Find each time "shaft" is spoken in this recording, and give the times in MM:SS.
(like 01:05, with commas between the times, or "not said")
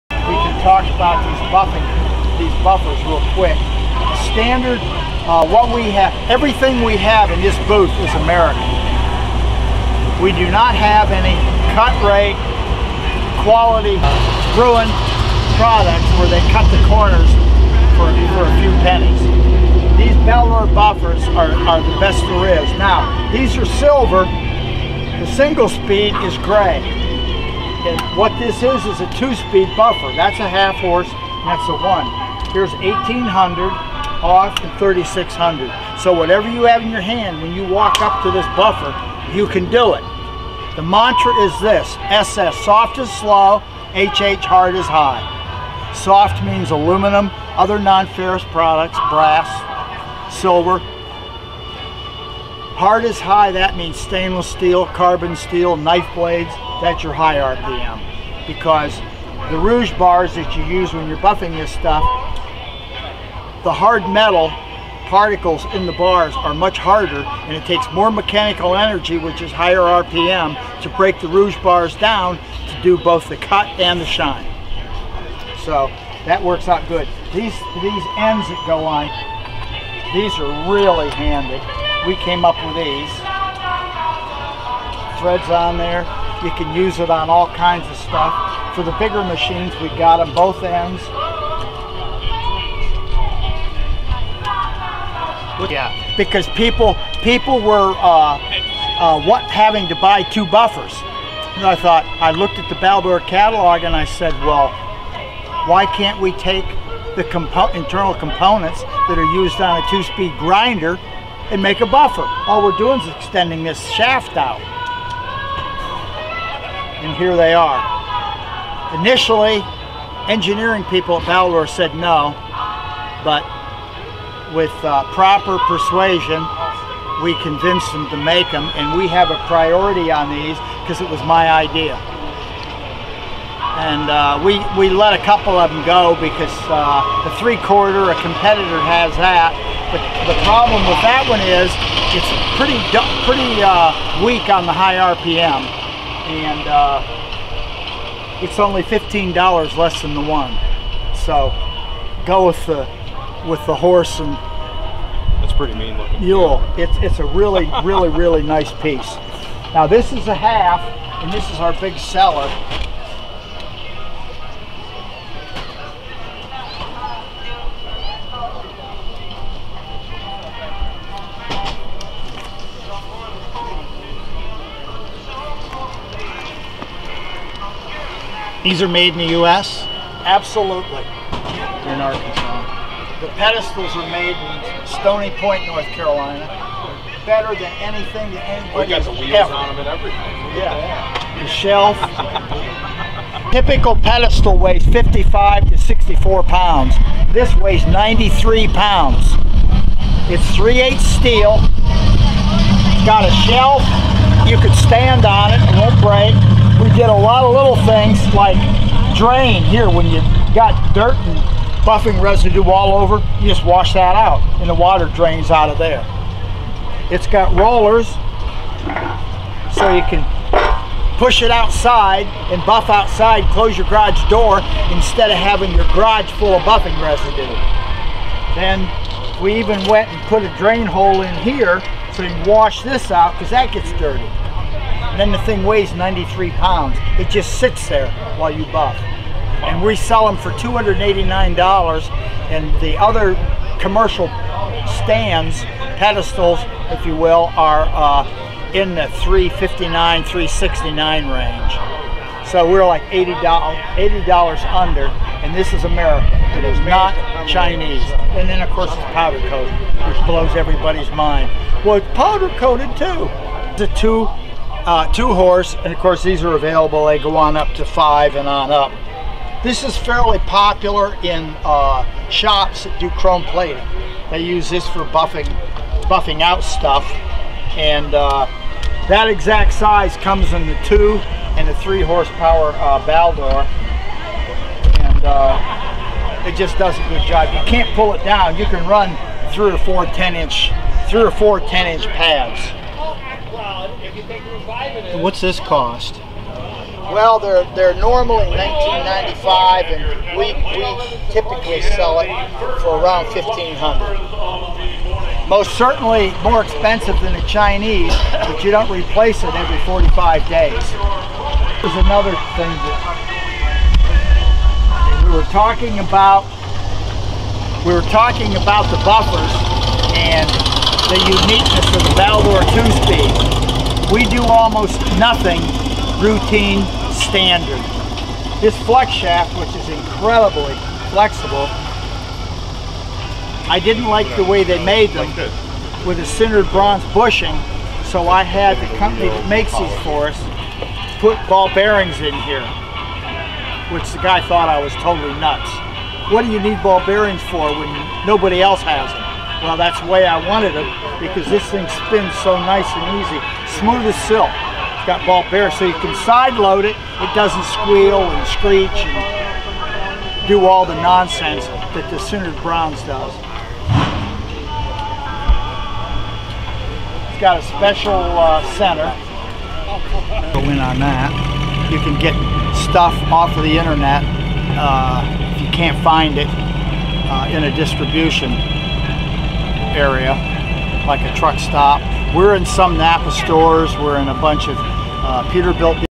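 01:53, 05:29.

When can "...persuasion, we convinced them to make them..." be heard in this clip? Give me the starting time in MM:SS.
02:05.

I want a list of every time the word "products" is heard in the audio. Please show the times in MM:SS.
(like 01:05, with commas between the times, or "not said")
00:15, 00:48.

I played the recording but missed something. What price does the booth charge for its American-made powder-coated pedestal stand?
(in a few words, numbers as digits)
$289.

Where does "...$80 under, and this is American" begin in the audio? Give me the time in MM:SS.
04:13.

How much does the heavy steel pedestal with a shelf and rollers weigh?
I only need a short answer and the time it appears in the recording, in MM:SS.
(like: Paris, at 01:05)
93 pounds, at 03:17.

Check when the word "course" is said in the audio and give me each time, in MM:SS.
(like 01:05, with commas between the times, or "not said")
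04:18, 04:25.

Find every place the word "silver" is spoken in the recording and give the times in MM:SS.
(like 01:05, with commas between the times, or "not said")
00:23, 00:50.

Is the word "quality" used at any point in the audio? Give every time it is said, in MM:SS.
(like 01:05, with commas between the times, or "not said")
00:13.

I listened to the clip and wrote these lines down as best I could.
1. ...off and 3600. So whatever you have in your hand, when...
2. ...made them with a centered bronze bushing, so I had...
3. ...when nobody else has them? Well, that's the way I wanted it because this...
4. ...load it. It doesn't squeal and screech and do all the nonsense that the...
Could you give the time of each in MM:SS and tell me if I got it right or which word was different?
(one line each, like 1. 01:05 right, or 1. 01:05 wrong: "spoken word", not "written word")
1. 00:34 right
2. 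05:34 right
3. 05:47 right
4. 05:56 right.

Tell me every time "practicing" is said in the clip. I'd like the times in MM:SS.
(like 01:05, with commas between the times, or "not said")
not said.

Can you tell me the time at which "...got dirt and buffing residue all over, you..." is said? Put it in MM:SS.
03:30.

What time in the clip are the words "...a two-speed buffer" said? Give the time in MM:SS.
00:29.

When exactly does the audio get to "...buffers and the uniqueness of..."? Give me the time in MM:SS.
05:19.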